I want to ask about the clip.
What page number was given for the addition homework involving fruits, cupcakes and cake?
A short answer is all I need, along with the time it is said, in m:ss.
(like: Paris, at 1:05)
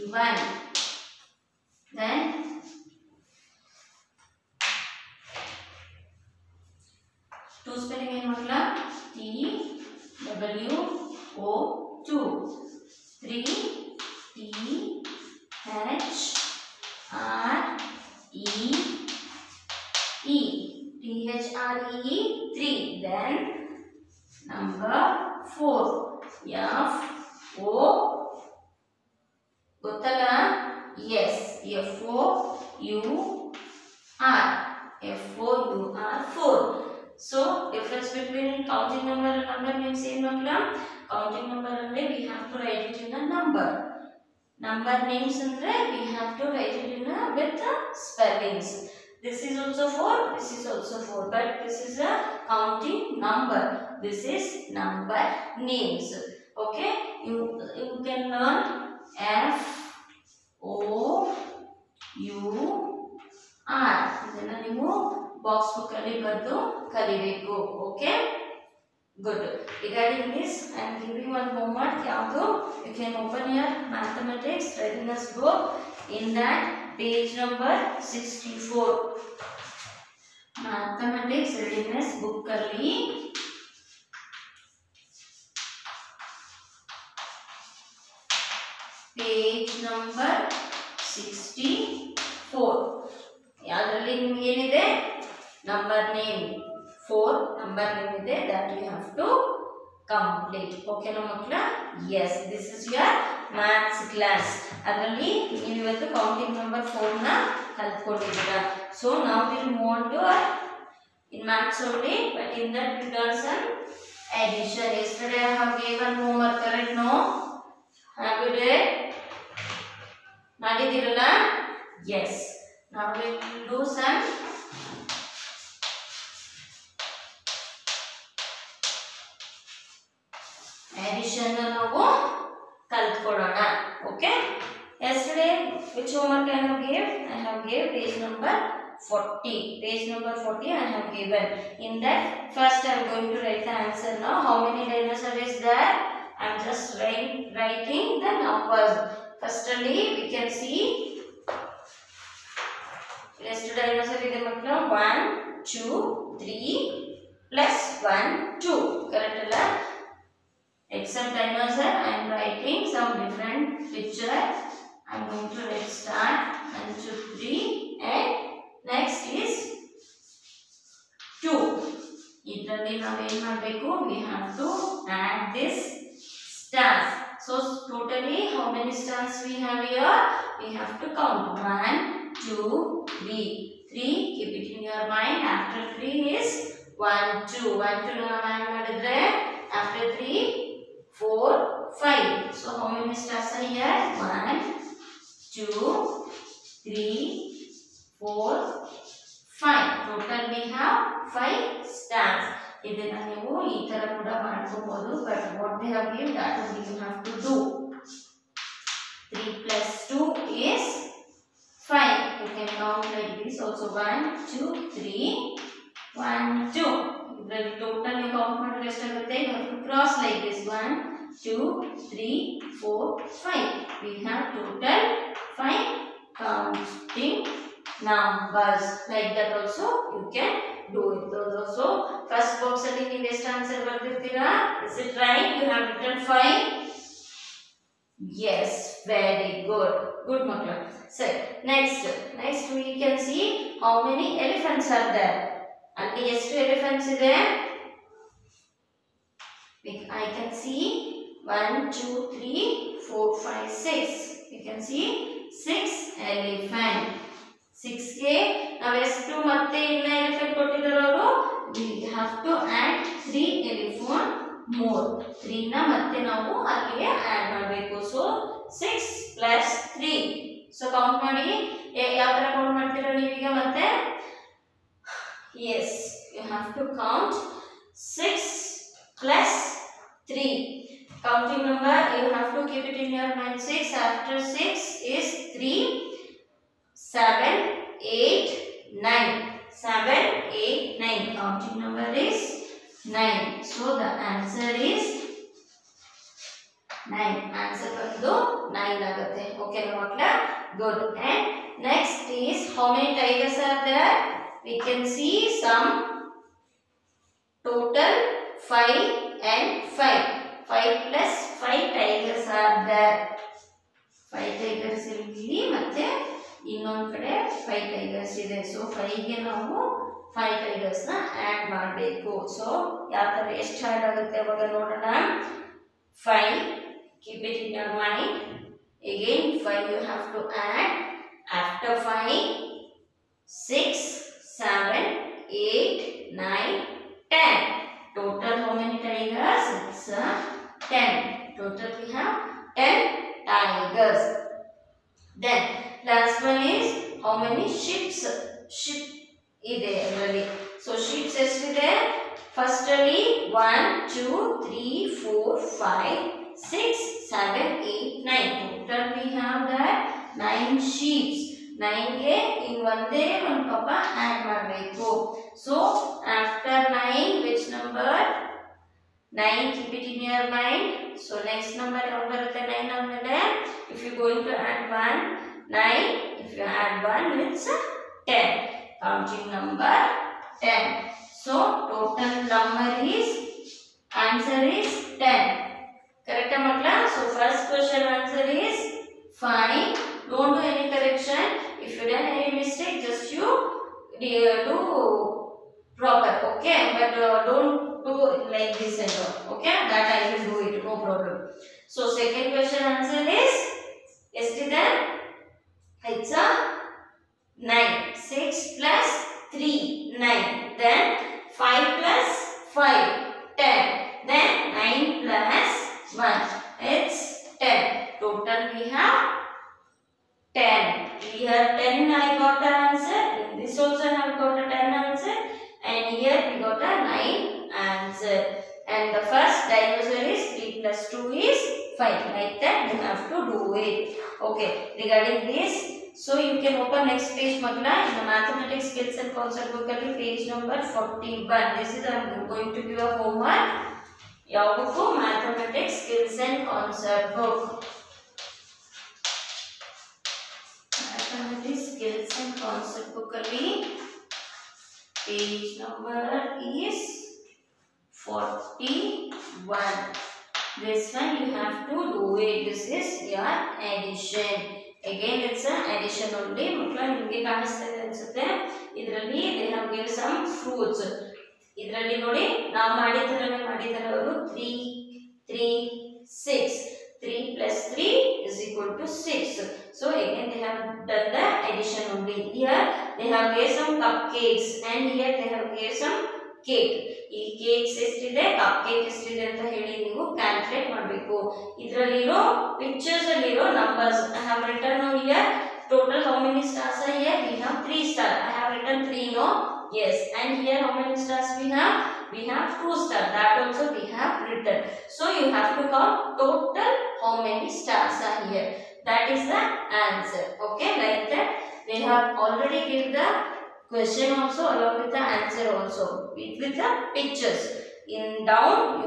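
41, at 7:19.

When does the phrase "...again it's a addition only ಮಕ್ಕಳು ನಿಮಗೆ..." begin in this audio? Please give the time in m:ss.
7:45.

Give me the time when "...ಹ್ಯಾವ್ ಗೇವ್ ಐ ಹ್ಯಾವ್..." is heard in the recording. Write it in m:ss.
2:16.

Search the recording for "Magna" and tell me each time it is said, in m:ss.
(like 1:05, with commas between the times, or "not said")
7:17.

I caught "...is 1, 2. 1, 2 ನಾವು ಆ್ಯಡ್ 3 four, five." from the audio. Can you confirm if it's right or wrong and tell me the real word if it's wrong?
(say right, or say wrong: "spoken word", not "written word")
right.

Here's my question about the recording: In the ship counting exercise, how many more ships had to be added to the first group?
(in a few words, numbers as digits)
1.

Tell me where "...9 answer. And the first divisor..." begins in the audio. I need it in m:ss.
7:07.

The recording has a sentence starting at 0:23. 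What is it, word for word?
Then number 4, Yes, F, O, Gotala, yes, F, O, U, R, F, O, U, R, 4.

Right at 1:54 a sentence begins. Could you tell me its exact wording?
Yesterday I have given homework, correct?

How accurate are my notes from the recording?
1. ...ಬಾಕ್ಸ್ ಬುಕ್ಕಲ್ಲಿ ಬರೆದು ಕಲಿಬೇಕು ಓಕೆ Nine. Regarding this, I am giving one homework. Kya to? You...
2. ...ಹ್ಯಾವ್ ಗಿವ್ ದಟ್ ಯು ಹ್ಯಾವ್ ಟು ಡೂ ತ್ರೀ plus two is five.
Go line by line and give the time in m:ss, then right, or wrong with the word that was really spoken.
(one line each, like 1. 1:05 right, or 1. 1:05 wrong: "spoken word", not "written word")
1. 1:05 wrong: "Good", not "Nine"
2. 3:25 right.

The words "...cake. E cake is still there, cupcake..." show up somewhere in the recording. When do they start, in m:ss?
8:06.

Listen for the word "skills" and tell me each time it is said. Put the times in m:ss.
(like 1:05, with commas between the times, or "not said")
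7:18, 7:26, 7:31.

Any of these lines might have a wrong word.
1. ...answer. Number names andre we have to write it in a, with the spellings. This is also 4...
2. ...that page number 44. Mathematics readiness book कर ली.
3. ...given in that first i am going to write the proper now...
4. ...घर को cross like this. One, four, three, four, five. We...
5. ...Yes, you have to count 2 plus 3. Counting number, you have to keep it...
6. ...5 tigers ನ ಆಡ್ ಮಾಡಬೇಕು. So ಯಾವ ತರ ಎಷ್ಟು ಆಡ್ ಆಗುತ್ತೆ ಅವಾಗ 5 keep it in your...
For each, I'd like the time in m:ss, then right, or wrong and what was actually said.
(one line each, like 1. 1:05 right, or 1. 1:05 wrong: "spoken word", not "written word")
1. 0:43 wrong: "number", not "answer"
2. 1:16 wrong: "64", not "44"
3. 2:21 wrong: "answer", not "proper"
4. 3:39 wrong: "two", not "four"
5. 4:35 wrong: "6", not "2"
6. 5:20 right.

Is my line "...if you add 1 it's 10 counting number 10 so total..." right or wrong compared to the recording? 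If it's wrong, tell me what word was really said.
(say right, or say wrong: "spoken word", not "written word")
right.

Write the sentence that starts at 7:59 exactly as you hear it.
So again they have done the addition only.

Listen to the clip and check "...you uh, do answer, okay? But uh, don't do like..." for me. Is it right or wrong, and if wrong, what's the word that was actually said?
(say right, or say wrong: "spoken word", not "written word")
wrong: "proper", not "answer".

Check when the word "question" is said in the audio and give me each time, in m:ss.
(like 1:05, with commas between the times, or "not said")
6:27, 6:42, 8:33.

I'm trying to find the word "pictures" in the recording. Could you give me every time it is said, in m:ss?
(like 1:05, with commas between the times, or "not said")
2:43, 8:12, 8:37.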